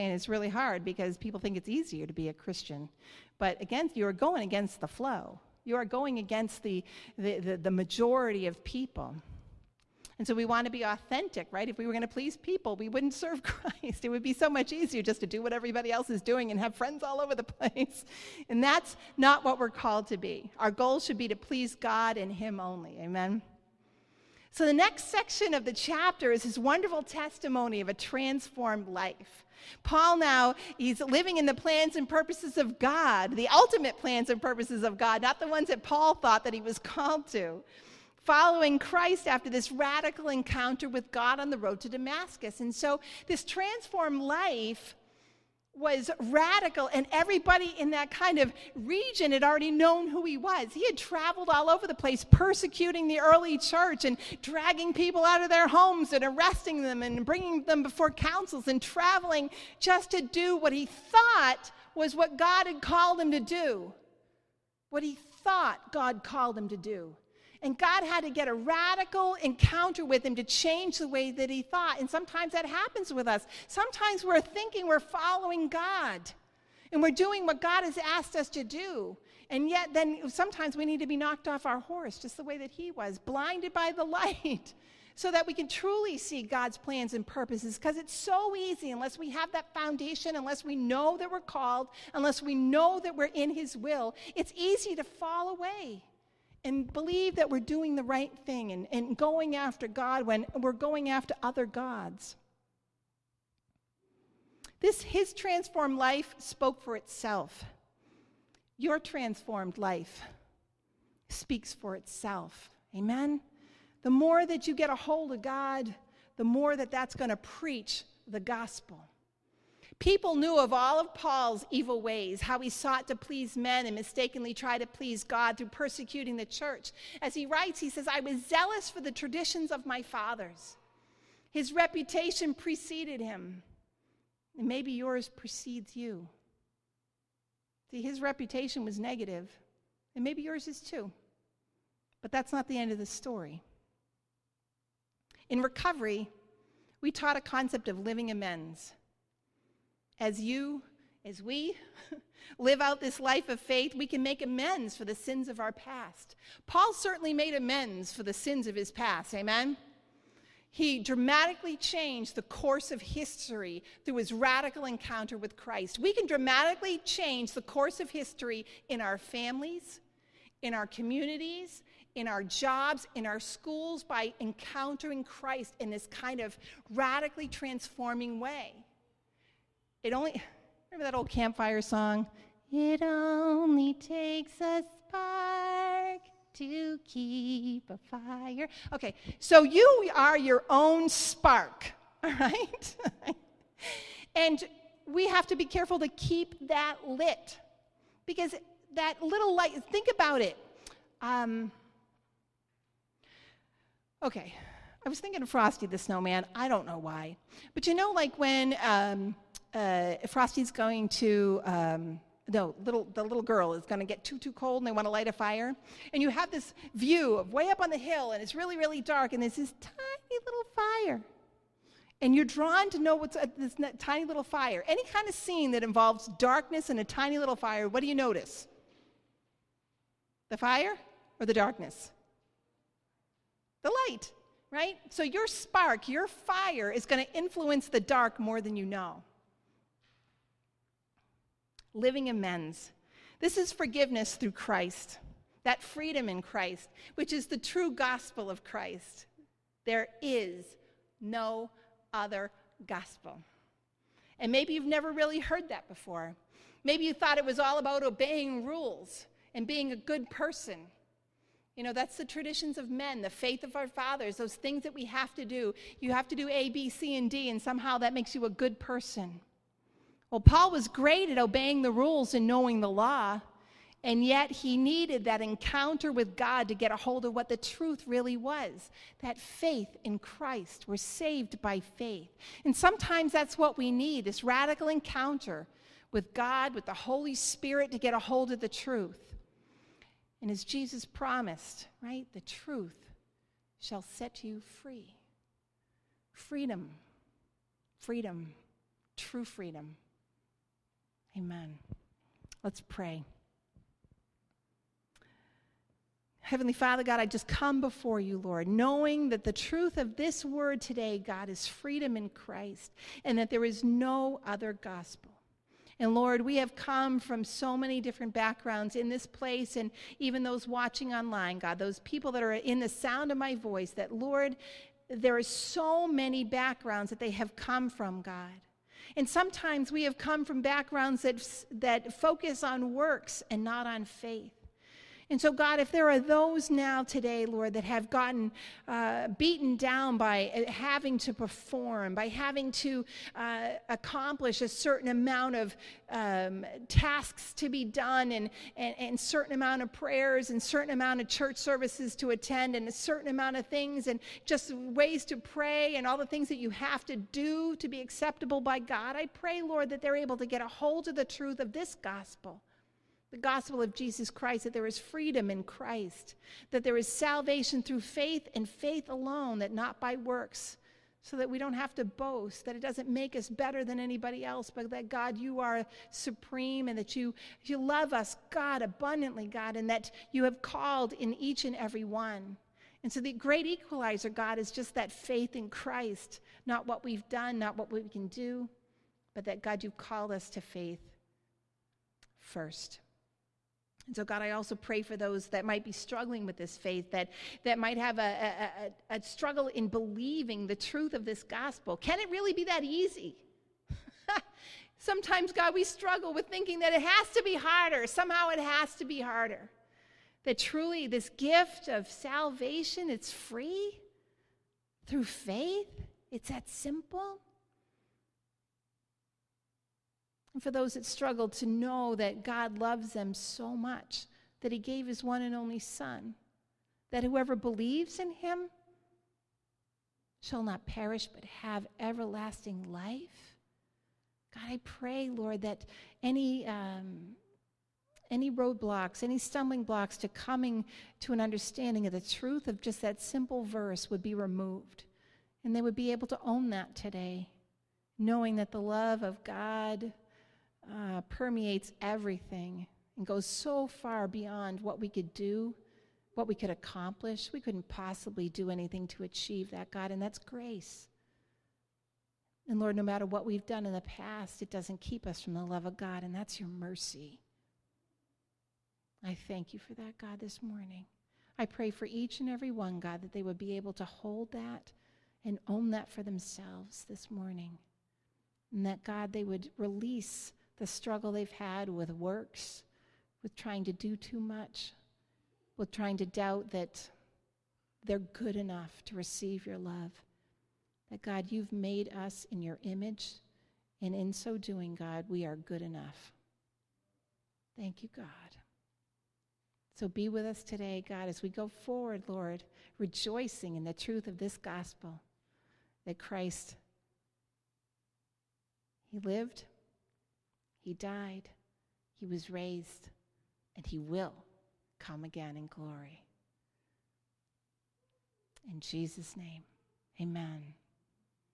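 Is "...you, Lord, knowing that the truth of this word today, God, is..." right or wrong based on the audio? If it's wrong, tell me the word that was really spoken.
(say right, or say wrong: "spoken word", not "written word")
right.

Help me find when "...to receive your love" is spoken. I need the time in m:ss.
8:09.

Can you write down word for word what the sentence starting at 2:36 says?
Paul certainly made amends for the sins of his past.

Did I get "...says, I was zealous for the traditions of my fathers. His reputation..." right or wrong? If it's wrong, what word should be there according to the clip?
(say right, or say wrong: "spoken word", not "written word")
right.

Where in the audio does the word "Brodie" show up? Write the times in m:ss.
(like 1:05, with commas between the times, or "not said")
not said.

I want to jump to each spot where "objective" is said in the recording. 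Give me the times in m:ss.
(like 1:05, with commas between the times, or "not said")
not said.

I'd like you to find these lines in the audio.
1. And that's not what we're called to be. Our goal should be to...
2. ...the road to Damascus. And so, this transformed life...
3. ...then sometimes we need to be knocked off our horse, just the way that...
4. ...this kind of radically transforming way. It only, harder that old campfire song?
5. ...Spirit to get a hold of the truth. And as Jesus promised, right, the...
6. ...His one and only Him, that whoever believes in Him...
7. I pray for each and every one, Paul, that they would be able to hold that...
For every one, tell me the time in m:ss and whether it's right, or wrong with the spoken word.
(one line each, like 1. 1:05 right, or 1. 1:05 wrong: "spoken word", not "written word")
1. 0:18 right
2. 0:41 right
3. 1:19 right
4. 2:55 wrong: "remember", not "harder"
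5. 4:47 right
6. 7:05 wrong: "Son", not "Him"
7. 7:51 wrong: "God", not "Paul".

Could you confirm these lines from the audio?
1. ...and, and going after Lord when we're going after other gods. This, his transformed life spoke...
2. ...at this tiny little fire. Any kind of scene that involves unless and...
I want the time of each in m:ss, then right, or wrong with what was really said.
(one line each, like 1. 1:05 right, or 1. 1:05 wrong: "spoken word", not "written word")
1. 1:38 wrong: "God", not "Lord"
2. 3:43 wrong: "darkness", not "unless".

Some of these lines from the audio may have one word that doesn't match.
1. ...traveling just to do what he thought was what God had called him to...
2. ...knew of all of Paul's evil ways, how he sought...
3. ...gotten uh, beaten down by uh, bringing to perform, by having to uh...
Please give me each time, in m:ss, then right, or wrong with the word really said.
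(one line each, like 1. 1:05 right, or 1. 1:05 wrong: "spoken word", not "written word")
1. 0:58 right
2. 2:00 right
3. 5:38 wrong: "having", not "bringing".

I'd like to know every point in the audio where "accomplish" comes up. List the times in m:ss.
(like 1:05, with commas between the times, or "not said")
5:43, 7:36.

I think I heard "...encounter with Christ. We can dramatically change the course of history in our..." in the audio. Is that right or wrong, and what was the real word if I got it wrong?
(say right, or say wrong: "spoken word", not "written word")
right.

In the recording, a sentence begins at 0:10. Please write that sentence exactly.
And so we want to be authentic, right?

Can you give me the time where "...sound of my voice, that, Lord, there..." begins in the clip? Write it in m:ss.
5:22.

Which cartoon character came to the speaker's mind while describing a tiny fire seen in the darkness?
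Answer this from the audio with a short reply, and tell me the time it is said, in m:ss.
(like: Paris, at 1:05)
Frosty the Snowman, at 3:25.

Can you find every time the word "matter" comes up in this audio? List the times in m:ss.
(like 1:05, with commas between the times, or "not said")
7:43.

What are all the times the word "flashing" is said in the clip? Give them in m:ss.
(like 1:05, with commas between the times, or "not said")
not said.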